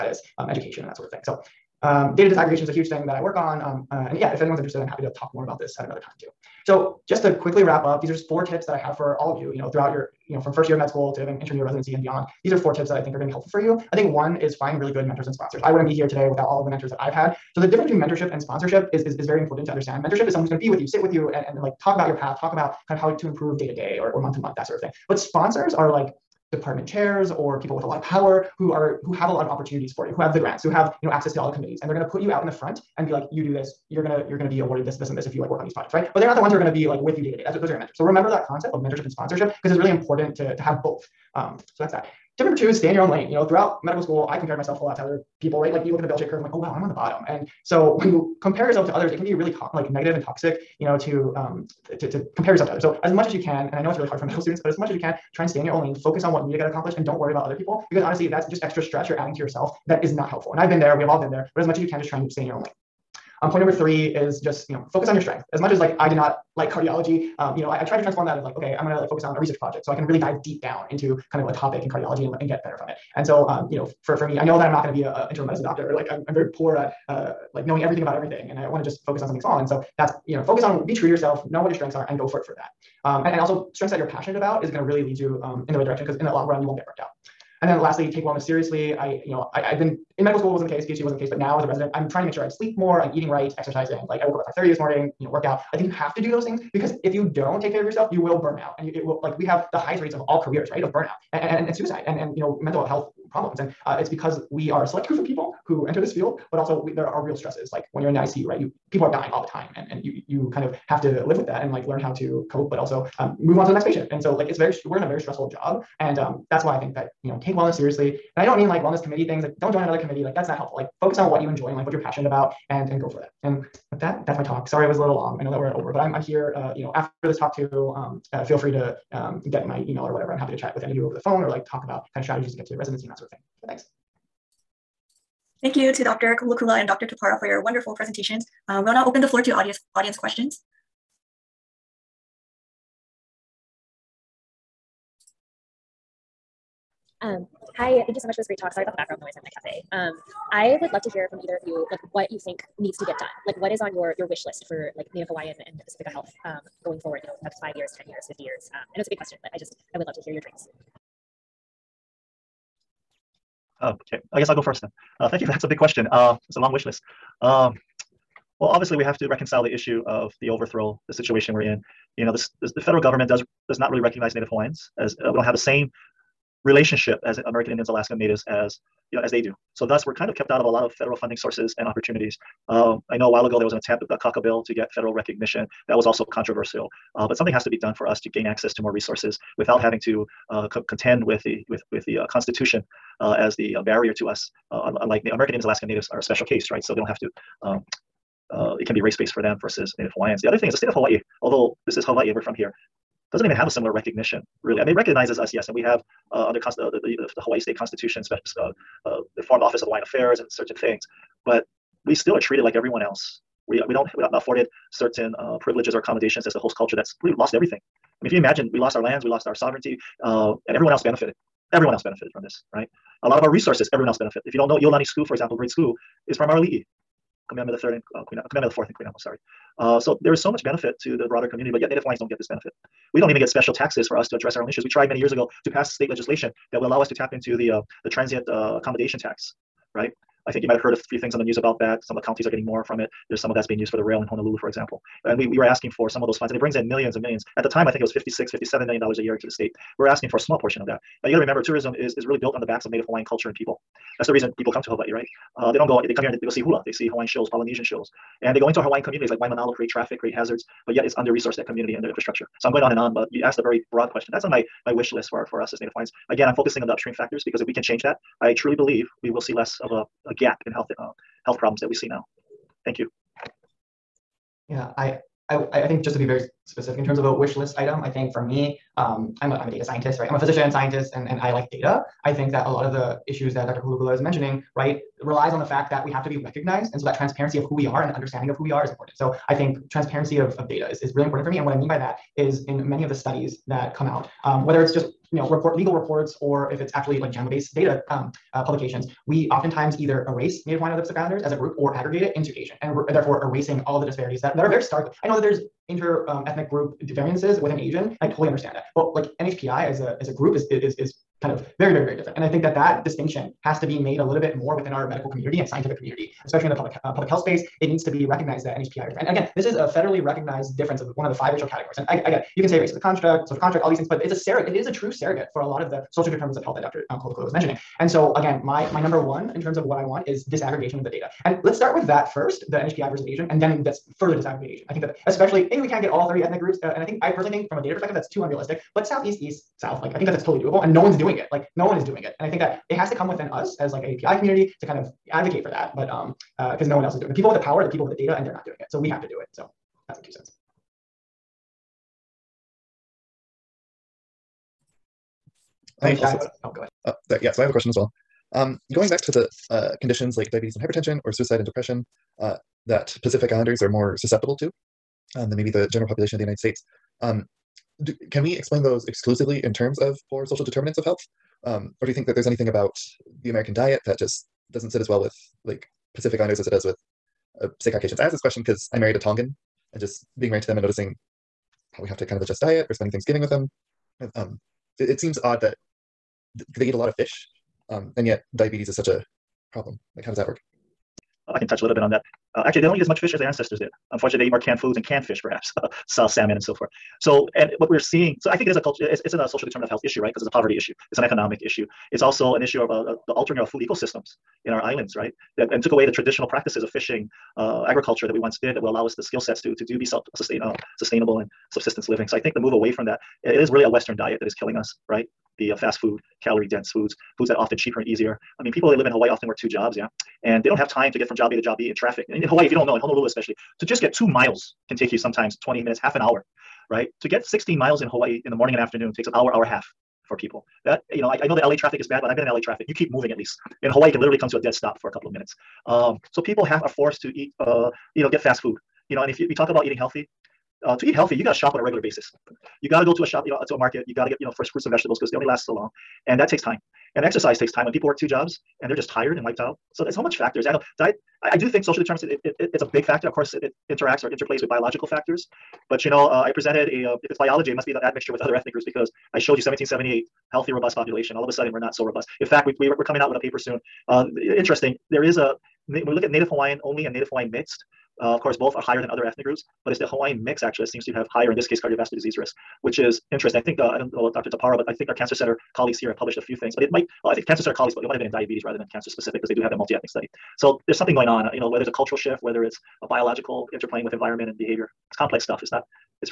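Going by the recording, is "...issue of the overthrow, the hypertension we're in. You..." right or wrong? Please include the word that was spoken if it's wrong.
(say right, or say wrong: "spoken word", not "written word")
wrong: "situation", not "hypertension".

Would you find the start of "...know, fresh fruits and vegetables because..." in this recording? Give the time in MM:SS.
07:24.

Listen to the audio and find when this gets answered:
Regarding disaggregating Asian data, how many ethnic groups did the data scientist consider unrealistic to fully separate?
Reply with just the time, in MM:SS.
05:36.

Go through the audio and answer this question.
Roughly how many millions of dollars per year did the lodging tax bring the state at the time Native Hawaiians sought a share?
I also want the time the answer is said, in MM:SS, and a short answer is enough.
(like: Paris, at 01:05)
56 to 57 million, at 04:08.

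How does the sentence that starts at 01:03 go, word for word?
Um, point number three is just you know focus on your strength.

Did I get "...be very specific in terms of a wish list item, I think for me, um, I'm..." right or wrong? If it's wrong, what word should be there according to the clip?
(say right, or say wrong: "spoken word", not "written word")
right.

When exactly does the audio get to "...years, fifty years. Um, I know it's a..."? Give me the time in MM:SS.
02:38.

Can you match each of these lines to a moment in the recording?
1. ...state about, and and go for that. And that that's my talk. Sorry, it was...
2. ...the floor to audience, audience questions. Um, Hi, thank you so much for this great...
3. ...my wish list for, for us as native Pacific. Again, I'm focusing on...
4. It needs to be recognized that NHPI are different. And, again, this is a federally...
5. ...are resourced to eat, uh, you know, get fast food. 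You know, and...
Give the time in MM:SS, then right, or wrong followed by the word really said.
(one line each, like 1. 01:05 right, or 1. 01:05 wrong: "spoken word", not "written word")
1. 02:02 wrong: "passionate", not "state"
2. 02:19 right
3. 04:24 wrong: "Hawaiians", not "Pacific"
4. 05:17 right
5. 07:16 wrong: "forced", not "resourced".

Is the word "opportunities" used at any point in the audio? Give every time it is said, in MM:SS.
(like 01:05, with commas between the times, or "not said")
00:29, 03:01.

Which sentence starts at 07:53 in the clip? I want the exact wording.
I think, uh, I don't know about Dr.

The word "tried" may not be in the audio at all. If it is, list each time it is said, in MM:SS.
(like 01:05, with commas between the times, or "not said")
01:07, 03:54.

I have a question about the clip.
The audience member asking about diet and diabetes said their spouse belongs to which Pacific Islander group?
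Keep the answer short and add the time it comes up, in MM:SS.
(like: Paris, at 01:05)
Tongan, at 06:19.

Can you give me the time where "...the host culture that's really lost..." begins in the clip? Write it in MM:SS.
03:36.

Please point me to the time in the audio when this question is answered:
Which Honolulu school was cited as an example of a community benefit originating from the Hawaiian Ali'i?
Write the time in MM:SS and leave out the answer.
03:44.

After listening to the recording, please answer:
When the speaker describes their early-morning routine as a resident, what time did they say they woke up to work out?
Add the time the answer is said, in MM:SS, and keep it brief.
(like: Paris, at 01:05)
5:30, at 01:34.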